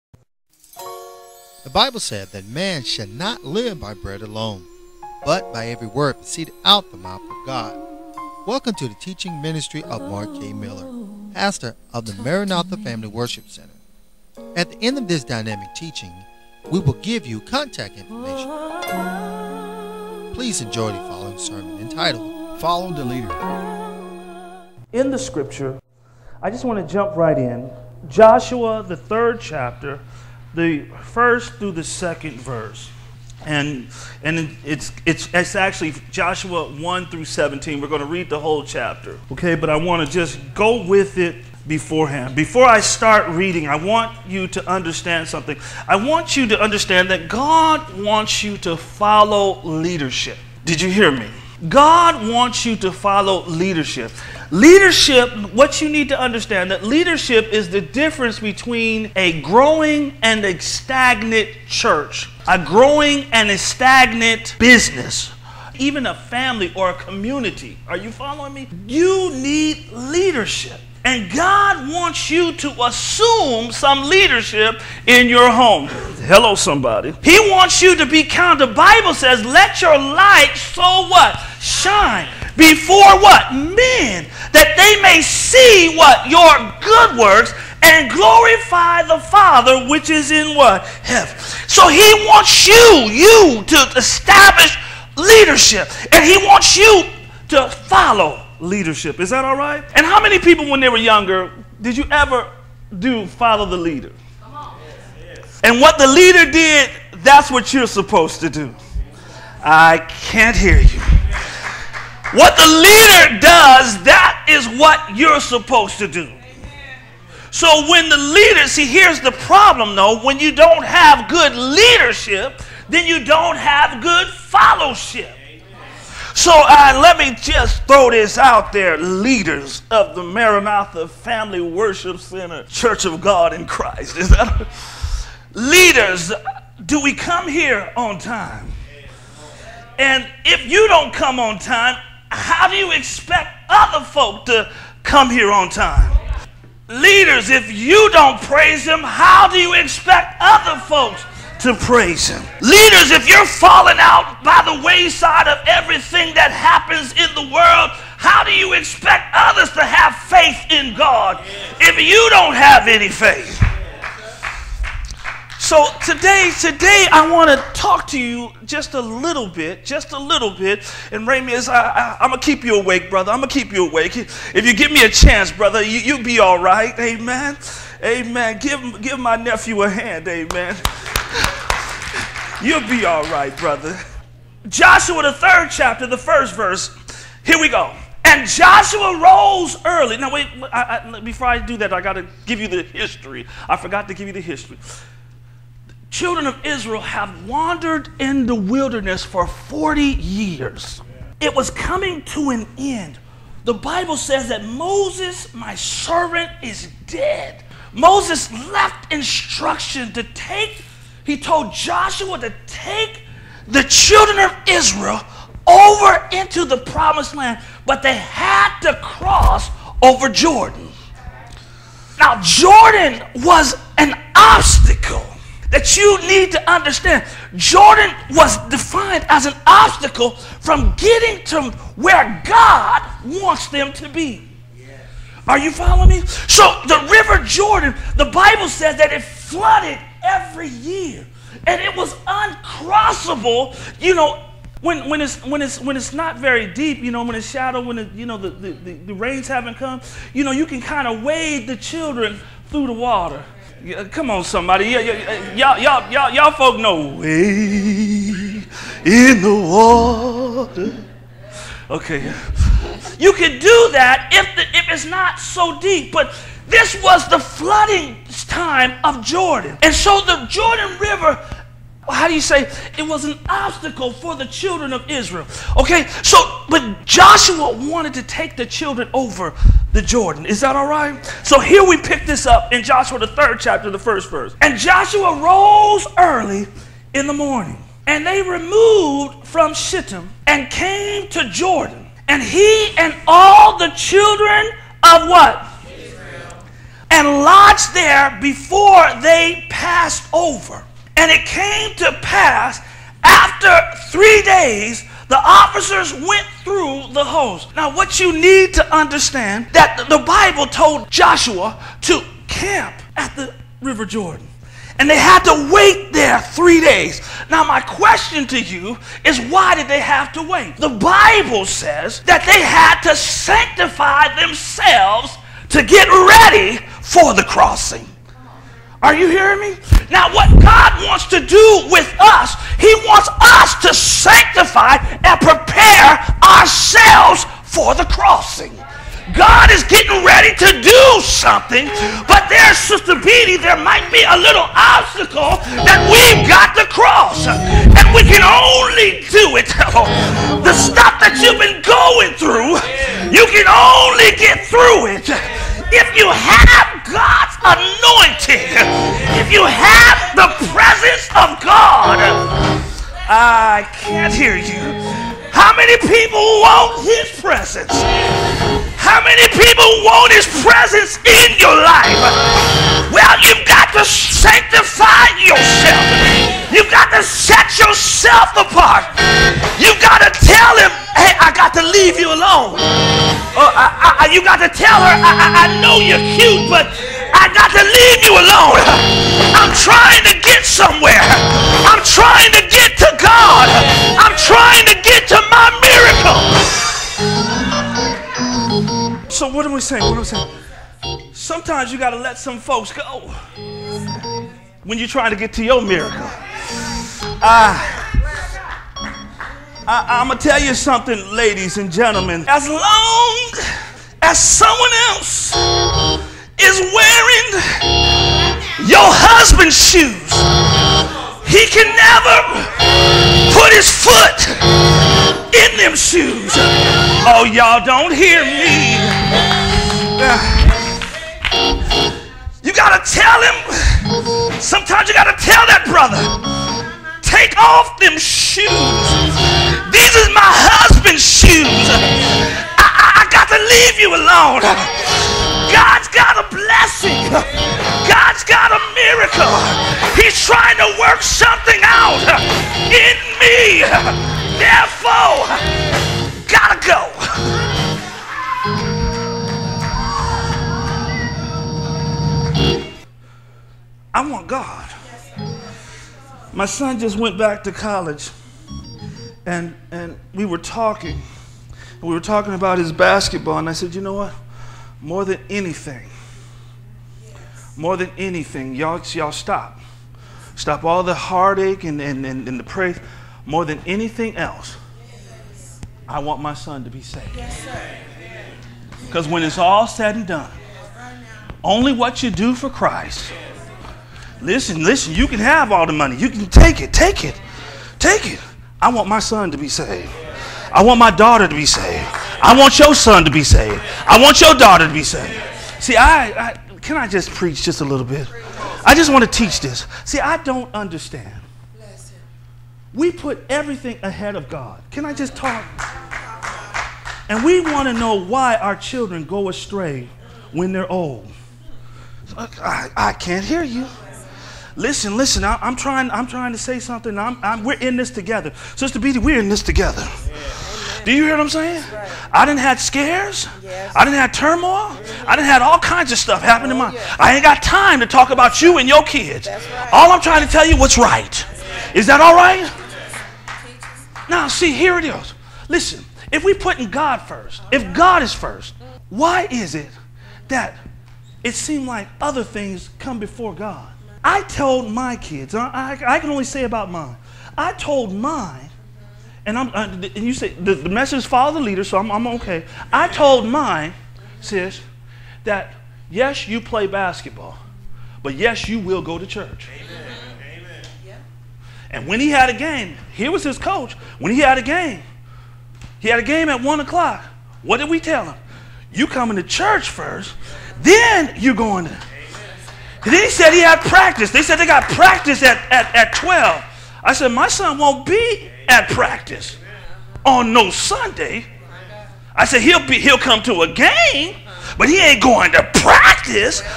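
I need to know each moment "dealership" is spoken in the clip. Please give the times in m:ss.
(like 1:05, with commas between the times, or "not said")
not said.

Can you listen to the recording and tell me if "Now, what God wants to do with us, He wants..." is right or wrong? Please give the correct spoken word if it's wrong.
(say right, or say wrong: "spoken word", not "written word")
right.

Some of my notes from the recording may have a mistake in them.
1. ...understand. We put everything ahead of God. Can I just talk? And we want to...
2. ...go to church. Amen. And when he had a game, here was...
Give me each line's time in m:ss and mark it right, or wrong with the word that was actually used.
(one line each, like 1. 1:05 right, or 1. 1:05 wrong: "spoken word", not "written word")
1. 8:30 right
2. 9:29 right.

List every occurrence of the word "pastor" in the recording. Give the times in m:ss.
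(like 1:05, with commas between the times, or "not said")
0:11.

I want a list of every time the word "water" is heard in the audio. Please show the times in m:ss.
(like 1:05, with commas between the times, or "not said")
4:12, 4:20.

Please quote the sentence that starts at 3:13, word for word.
I forgot to give you the history.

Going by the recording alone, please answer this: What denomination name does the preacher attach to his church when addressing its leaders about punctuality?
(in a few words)
Church of God in Christ.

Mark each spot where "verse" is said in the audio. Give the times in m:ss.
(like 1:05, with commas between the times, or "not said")
0:32, 3:06, 4:44.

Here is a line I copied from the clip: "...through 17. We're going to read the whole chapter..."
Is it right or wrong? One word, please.
right.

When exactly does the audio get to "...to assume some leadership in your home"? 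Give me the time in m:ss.
1:12.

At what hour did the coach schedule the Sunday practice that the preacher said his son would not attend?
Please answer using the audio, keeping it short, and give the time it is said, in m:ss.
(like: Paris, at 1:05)
12, at 9:46.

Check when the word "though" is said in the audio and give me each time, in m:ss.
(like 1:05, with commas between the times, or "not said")
1:59.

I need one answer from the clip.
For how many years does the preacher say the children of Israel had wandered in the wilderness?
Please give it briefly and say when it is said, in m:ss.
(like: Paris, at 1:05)
40, at 3:19.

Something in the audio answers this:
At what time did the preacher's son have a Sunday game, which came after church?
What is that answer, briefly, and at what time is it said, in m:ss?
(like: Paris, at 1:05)
1 o'clock, at 9:36.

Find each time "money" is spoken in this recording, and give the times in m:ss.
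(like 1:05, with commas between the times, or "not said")
8:15.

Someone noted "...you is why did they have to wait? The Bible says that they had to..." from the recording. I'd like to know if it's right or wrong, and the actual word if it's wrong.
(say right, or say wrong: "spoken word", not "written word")
right.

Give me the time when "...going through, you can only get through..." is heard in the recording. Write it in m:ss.
5:51.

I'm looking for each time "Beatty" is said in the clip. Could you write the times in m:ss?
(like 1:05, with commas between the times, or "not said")
5:43, 8:48.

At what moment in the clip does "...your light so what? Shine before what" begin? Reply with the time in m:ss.
1:19.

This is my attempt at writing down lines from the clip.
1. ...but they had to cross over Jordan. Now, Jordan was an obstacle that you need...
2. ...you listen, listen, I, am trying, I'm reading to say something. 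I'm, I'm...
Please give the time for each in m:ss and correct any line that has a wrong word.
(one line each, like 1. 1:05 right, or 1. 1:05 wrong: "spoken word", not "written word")
1. 3:37 right
2. 8:43 wrong: "trying", not "reading".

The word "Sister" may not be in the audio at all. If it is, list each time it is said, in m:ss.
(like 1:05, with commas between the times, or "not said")
5:42, 8:48.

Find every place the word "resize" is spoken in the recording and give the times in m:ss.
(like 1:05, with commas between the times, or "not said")
not said.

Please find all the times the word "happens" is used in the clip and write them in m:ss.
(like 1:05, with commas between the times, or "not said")
2:36, 8:56.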